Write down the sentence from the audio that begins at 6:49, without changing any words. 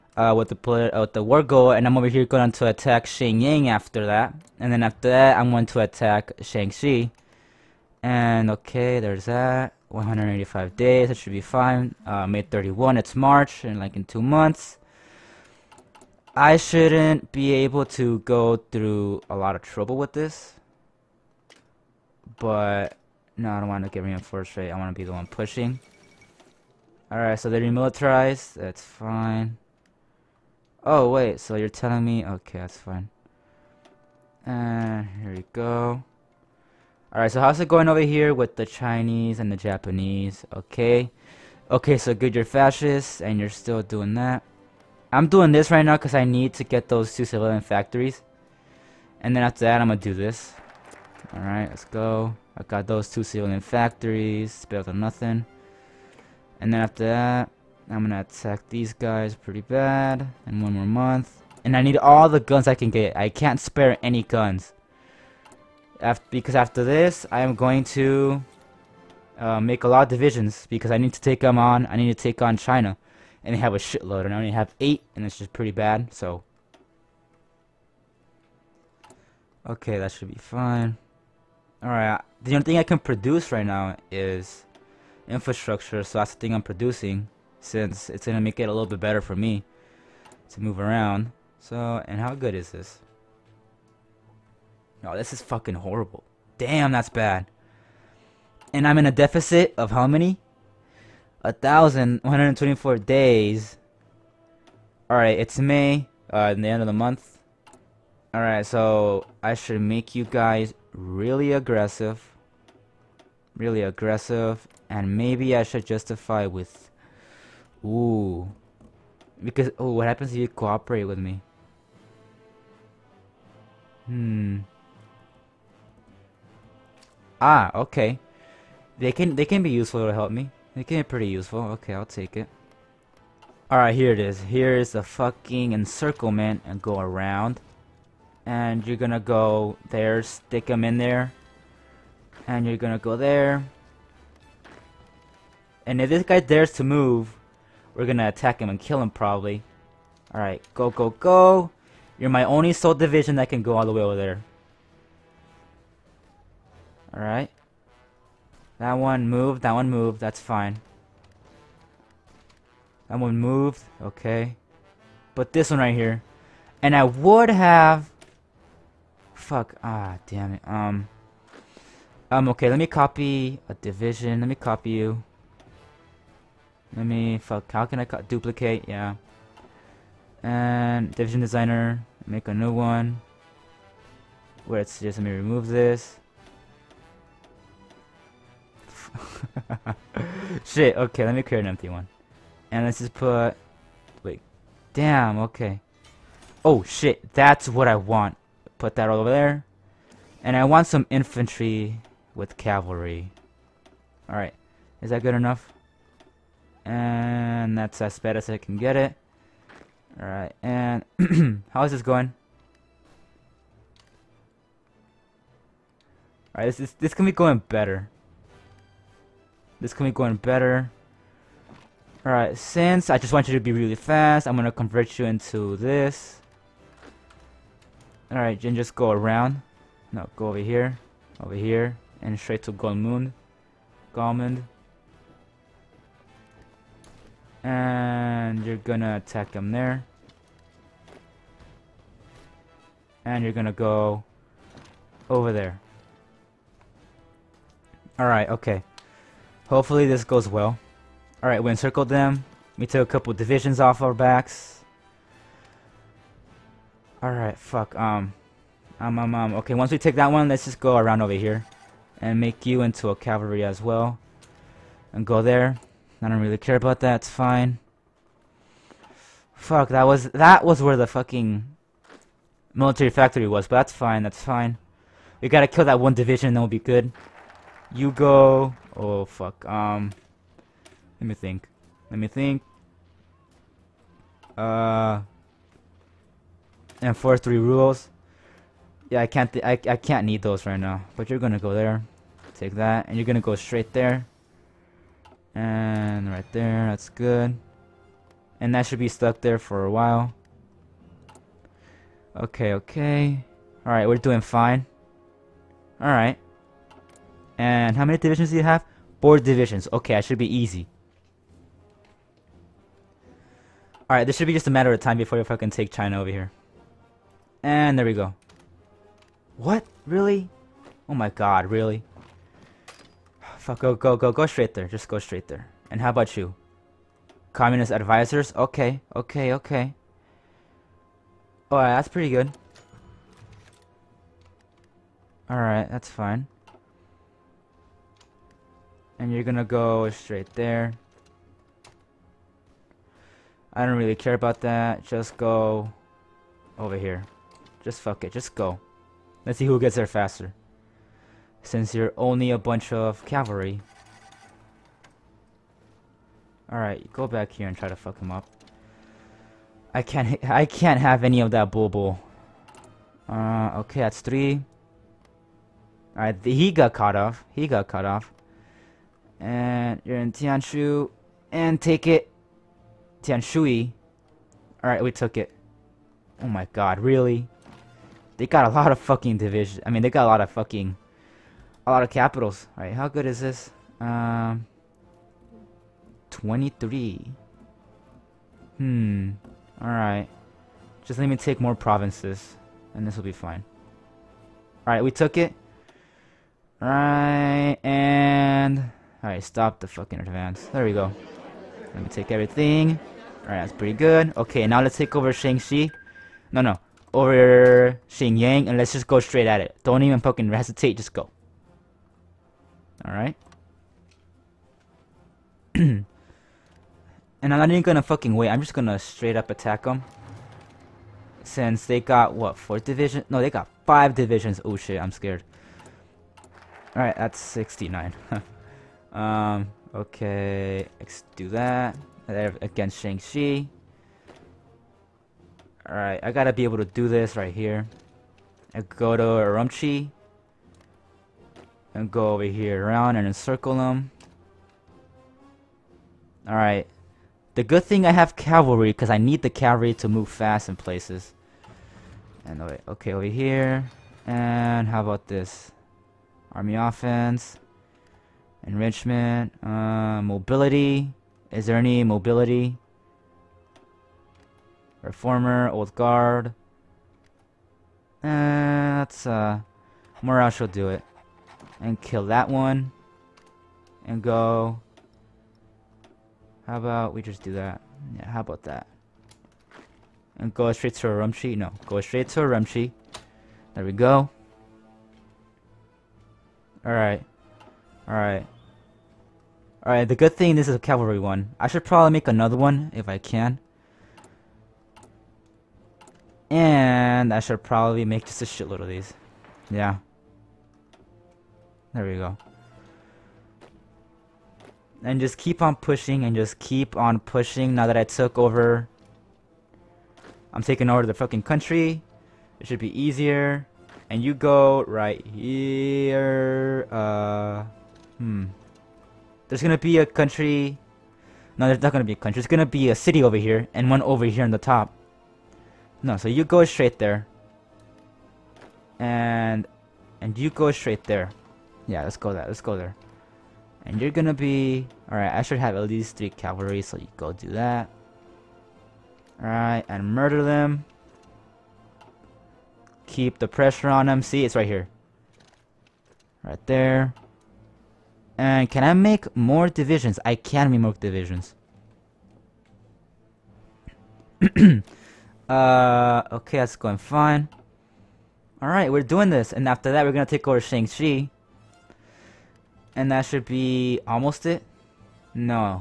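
Don't even fucking hesitate, just go.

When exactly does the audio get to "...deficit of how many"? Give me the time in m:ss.
1:39.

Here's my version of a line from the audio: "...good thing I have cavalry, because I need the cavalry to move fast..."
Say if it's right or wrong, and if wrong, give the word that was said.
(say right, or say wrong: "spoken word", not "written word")
right.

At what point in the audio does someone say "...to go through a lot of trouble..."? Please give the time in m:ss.
0:17.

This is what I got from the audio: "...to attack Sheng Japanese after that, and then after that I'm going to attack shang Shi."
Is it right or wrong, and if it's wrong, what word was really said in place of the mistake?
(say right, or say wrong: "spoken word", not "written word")
wrong: "Ying", not "Japanese".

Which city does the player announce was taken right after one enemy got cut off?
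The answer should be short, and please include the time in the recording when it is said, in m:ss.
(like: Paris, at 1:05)
Tianshui, at 6:13.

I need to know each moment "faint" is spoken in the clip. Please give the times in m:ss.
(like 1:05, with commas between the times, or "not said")
not said.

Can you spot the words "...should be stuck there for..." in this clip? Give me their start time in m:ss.
4:58.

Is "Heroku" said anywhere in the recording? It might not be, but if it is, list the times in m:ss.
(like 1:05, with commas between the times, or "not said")
not said.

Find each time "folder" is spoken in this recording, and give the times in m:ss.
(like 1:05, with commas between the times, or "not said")
not said.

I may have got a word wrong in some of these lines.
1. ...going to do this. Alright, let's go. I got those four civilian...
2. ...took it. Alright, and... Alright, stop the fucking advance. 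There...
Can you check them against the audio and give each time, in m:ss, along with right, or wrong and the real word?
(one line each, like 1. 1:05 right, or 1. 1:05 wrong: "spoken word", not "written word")
1. 0:49 wrong: "two", not "four"
2. 6:35 right.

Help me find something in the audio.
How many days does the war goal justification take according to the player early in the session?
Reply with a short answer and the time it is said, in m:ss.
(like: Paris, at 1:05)
185, at 0:09.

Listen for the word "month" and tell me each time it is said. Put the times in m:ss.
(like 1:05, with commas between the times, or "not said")
0:14, 1:00, 1:46.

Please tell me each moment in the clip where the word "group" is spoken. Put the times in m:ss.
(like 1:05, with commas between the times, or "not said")
not said.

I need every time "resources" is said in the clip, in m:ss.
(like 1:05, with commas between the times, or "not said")
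not said.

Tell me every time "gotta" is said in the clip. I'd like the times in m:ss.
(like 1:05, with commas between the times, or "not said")
4:35, 7:16.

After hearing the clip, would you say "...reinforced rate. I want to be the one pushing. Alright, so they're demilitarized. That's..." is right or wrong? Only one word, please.
right.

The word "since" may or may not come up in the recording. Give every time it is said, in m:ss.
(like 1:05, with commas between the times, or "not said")
1:27, 3:42, 5:51, 7:01.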